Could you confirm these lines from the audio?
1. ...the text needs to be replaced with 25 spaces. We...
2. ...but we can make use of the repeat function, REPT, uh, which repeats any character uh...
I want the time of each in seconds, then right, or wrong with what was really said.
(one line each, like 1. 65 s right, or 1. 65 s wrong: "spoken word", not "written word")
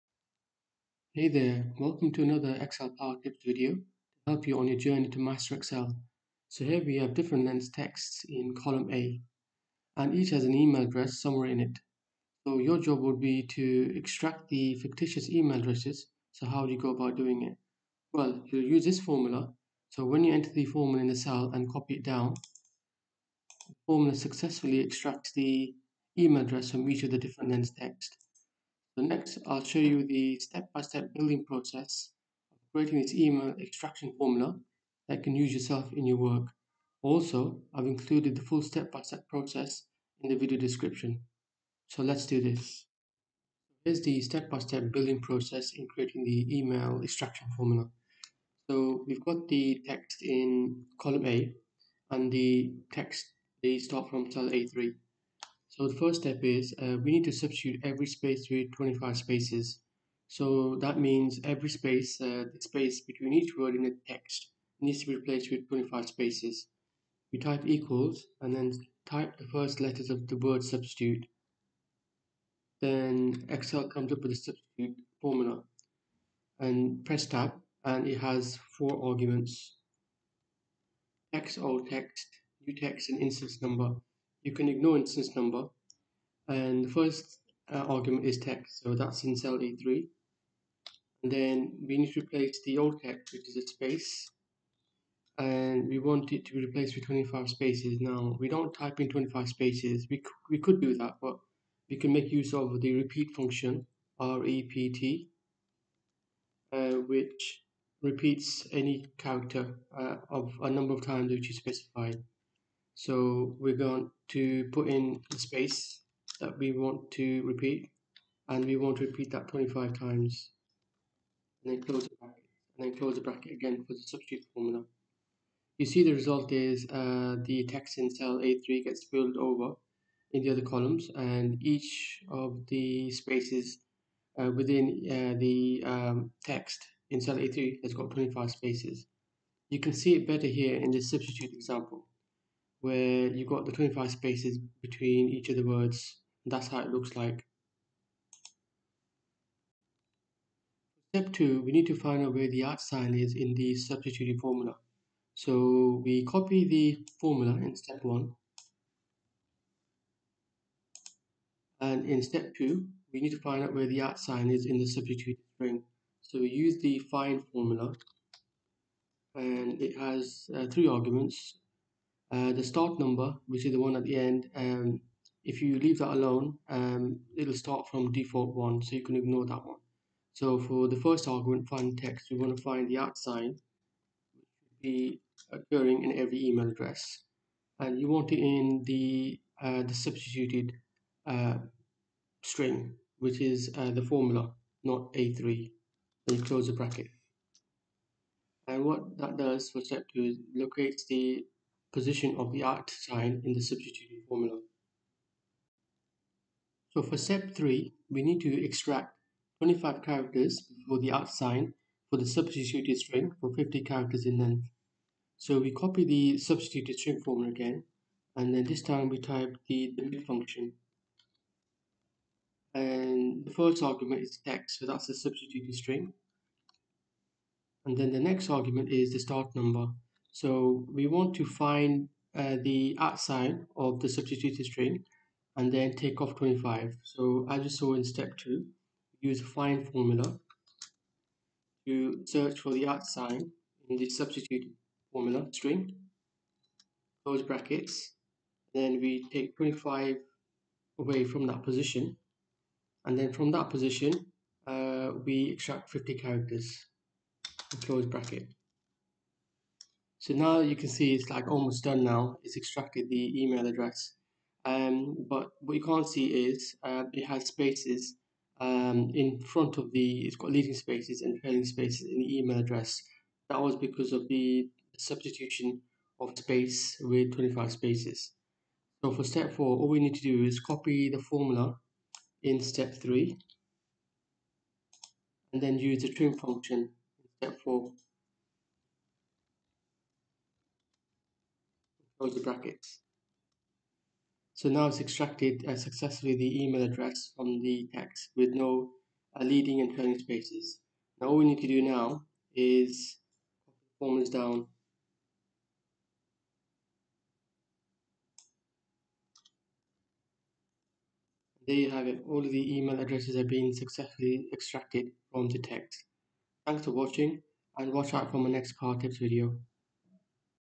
1. 63 s right
2. 101 s right.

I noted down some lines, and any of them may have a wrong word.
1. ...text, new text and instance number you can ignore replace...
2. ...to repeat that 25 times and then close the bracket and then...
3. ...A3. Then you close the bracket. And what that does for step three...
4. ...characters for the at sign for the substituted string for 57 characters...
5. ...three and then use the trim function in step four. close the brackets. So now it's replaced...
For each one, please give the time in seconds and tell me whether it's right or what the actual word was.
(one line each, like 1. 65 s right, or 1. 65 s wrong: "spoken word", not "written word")
1. 81 s wrong: "instance", not "replace"
2. 118 s right
3. 195 s wrong: "two", not "three"
4. 210 s wrong: "50", not "57"
5. 282 s wrong: "extracted", not "replaced".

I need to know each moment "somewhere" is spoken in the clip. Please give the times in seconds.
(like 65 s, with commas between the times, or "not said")
11 s.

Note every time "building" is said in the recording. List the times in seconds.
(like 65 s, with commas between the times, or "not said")
31 s, 44 s.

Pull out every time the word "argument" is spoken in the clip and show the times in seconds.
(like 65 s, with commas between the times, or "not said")
79 s, 87 s, 170 s, 181 s, 223 s, 228 s.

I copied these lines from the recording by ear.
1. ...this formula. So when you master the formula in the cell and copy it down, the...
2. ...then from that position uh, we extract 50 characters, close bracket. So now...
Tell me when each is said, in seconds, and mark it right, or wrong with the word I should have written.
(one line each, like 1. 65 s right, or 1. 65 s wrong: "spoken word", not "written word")
1. 18 s wrong: "enter", not "master"
2. 253 s right.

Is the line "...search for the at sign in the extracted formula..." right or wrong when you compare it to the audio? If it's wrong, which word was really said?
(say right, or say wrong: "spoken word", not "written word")
wrong: "substituted", not "extracted".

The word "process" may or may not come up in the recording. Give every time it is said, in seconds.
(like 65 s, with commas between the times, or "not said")
31 s, 39 s, 45 s.